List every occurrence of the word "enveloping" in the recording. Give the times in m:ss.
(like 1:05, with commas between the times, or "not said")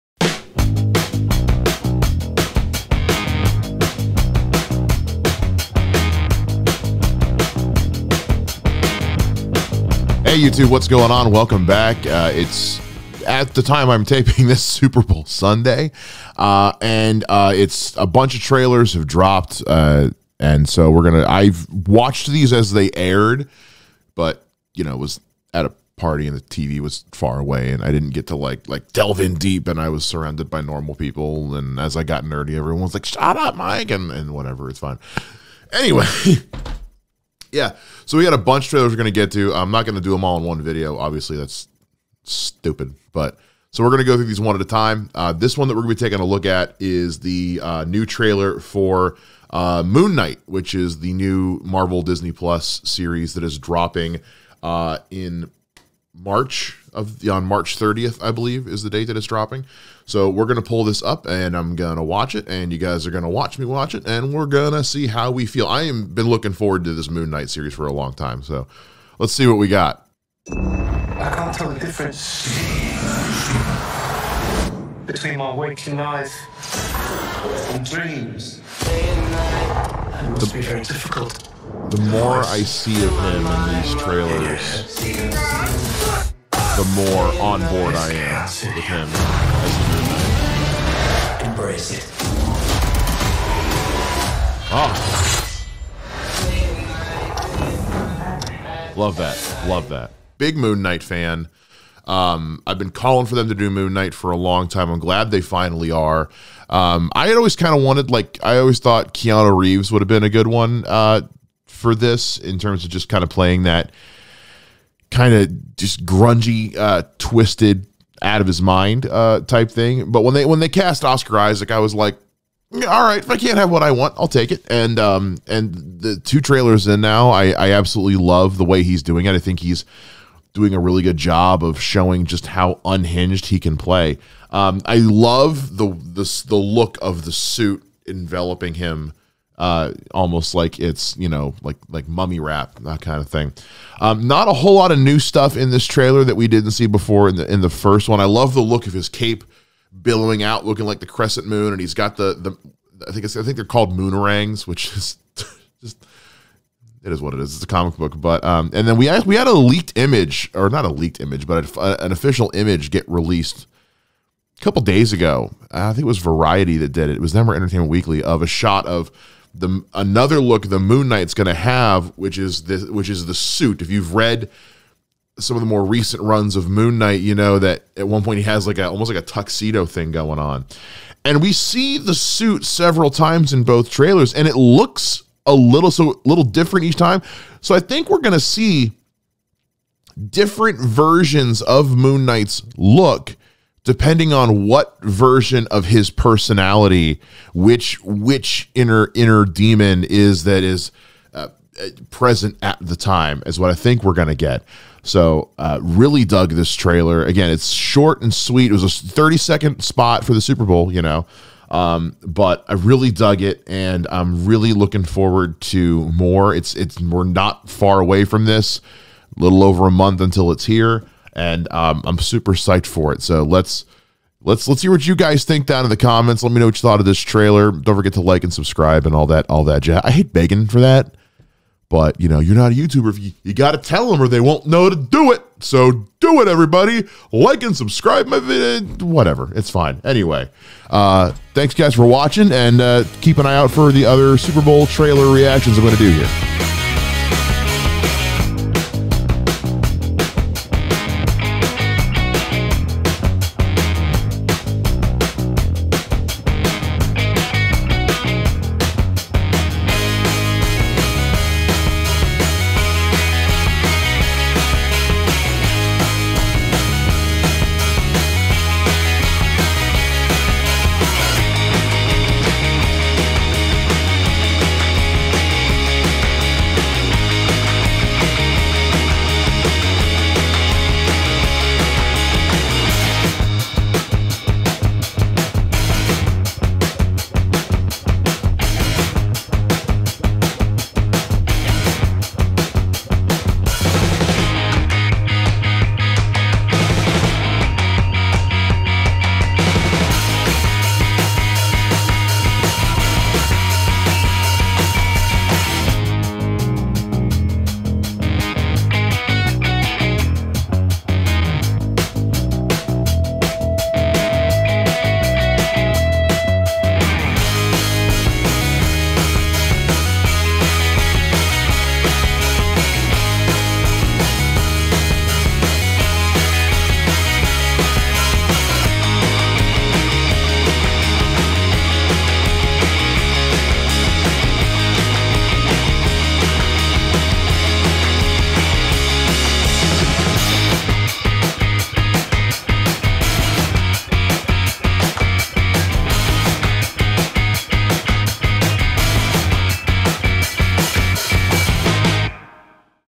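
2:18.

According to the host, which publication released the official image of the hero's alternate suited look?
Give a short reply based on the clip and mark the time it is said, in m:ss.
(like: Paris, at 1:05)
Entertainment Weekly, at 2:47.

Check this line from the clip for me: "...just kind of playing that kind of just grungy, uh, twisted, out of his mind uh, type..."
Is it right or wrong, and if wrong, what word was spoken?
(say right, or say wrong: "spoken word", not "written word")
right.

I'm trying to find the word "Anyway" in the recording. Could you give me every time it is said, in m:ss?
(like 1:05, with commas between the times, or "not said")
0:35, 4:00.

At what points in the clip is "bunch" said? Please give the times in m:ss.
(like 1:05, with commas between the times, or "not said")
0:18, 0:38.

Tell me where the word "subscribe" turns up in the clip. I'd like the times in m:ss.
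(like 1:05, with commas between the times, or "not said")
3:48, 3:57.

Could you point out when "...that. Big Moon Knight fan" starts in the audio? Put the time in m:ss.
1:39.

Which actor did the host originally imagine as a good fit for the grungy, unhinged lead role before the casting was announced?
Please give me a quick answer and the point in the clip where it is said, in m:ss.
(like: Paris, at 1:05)
Keanu Reeves, at 1:49.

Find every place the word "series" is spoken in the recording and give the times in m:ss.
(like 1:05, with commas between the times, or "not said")
0:52, 1:07.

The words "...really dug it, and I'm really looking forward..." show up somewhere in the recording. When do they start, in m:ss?
3:32.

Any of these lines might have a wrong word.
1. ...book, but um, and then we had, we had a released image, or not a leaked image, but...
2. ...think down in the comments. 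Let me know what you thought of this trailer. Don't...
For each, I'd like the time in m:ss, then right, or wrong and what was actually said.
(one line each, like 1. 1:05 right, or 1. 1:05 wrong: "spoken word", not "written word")
1. 2:37 wrong: "leaked", not "released"
2. 3:45 right.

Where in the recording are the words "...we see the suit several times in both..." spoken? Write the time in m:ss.
3:01.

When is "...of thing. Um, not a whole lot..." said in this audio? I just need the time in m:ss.
2:23.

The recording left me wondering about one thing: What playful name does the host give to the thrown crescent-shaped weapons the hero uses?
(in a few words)
moonerangs.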